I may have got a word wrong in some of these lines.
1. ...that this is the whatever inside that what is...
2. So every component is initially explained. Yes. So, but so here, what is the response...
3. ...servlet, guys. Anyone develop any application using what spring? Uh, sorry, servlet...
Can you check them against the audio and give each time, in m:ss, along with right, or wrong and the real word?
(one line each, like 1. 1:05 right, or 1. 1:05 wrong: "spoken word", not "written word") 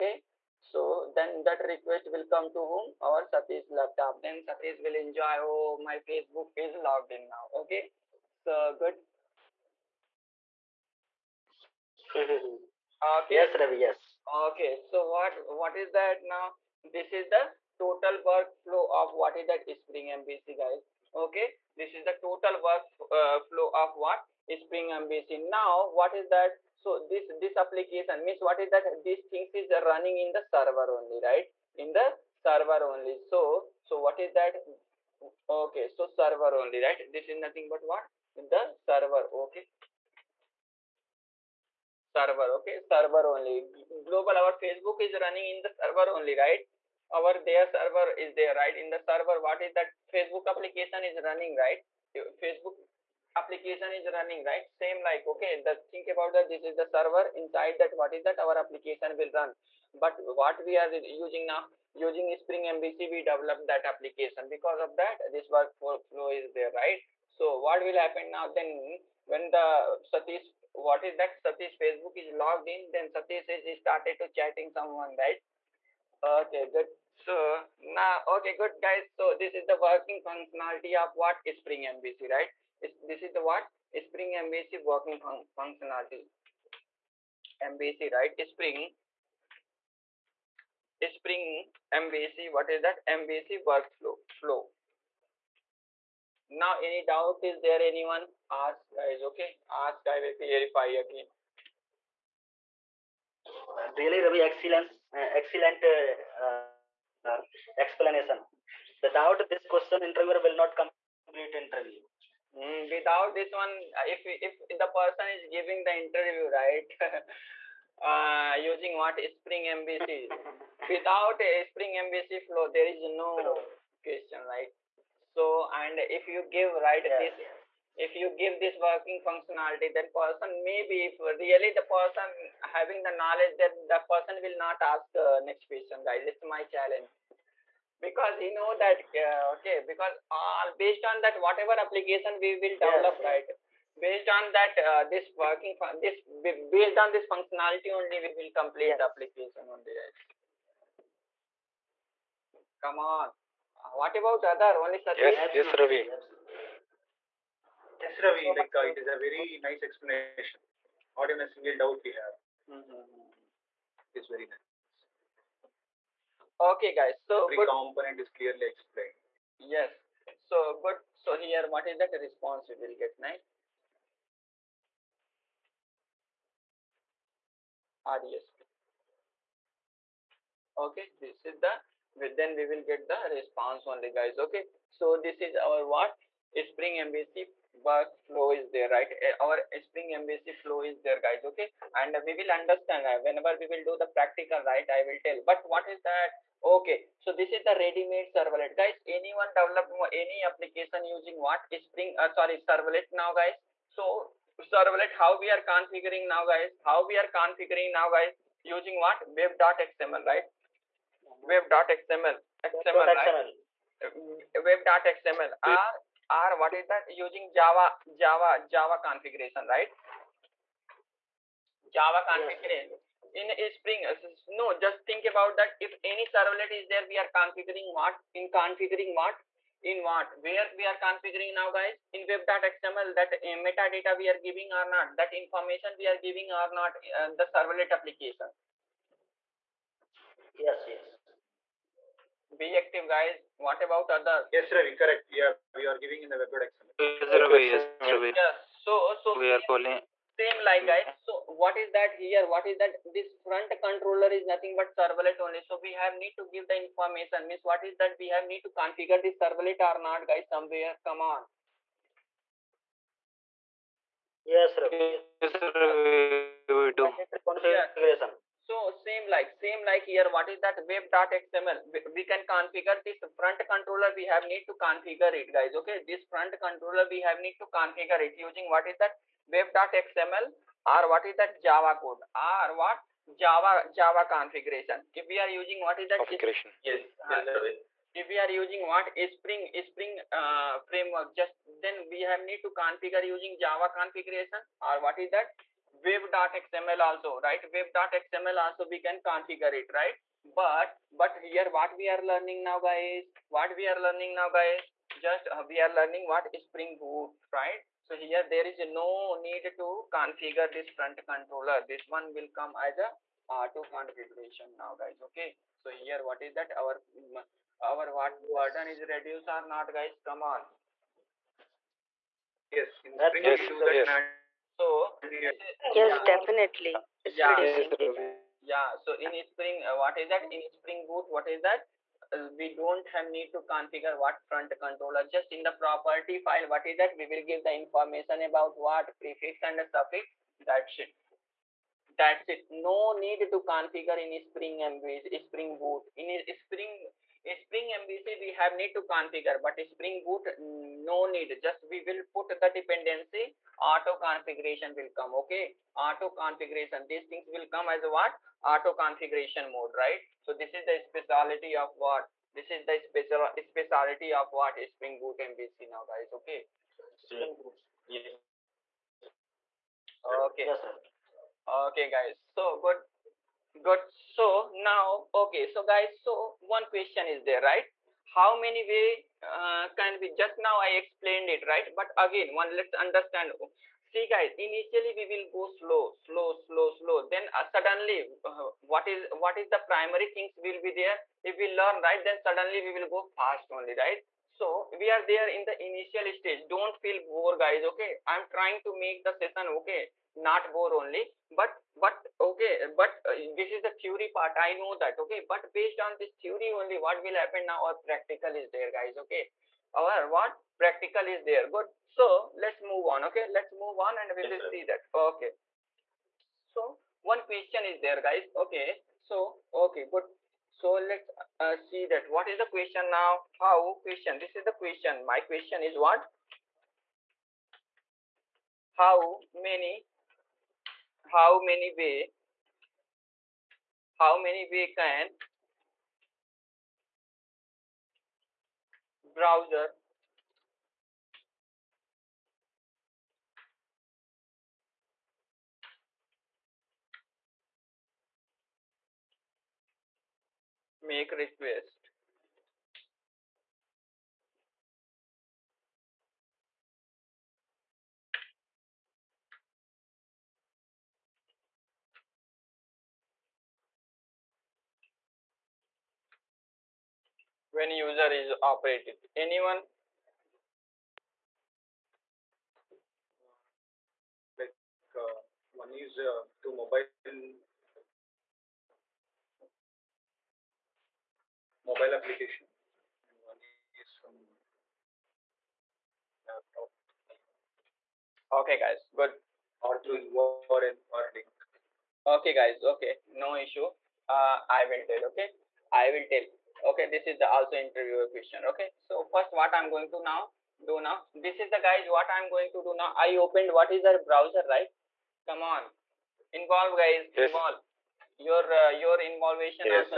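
1. 0:56 wrong: "server", not "whatever"
2. 2:47 wrong: "clearly", not "initially"
3. 3:18 right.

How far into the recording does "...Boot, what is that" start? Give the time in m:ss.
5:31.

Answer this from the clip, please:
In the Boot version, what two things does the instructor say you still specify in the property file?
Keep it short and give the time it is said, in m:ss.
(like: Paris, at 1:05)
prefix and suffix, at 5:39.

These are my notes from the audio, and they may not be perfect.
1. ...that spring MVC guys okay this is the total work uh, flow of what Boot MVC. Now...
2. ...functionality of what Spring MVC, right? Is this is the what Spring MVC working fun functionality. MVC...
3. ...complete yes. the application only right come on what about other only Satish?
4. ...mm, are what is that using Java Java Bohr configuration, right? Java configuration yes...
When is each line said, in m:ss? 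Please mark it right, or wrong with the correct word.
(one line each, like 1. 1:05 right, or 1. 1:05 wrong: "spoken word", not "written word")
1. 0:19 wrong: "Spring", not "Boot"
2. 1:20 right
3. 2:28 right
4. 3:35 wrong: "Java", not "Bohr".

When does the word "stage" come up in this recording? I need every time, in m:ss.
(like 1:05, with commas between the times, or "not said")
6:36.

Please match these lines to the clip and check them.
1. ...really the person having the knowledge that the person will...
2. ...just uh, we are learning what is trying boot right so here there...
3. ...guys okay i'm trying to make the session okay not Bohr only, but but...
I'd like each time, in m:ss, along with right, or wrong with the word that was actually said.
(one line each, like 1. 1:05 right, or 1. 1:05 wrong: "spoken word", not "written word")
1. 2:11 right
2. 5:05 wrong: "spring", not "trying"
3. 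6:37 right.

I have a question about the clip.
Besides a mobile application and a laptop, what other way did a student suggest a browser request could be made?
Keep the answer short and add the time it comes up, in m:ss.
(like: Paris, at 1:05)
URL or link, at 8:10.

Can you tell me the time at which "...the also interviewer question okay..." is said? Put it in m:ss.
8:17.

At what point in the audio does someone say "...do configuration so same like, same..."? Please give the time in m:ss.
4:26.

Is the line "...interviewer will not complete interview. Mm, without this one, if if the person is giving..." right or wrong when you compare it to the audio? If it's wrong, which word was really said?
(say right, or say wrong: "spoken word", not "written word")
right.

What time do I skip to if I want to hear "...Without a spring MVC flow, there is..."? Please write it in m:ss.
2:00.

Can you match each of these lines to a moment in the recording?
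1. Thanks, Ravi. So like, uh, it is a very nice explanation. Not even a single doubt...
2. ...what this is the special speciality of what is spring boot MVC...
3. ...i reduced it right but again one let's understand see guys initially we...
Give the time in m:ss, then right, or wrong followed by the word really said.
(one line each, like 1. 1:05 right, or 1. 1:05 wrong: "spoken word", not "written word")
1. 2:38 right
2. 6:01 right
3. 6:20 wrong: "explained", not "reduced".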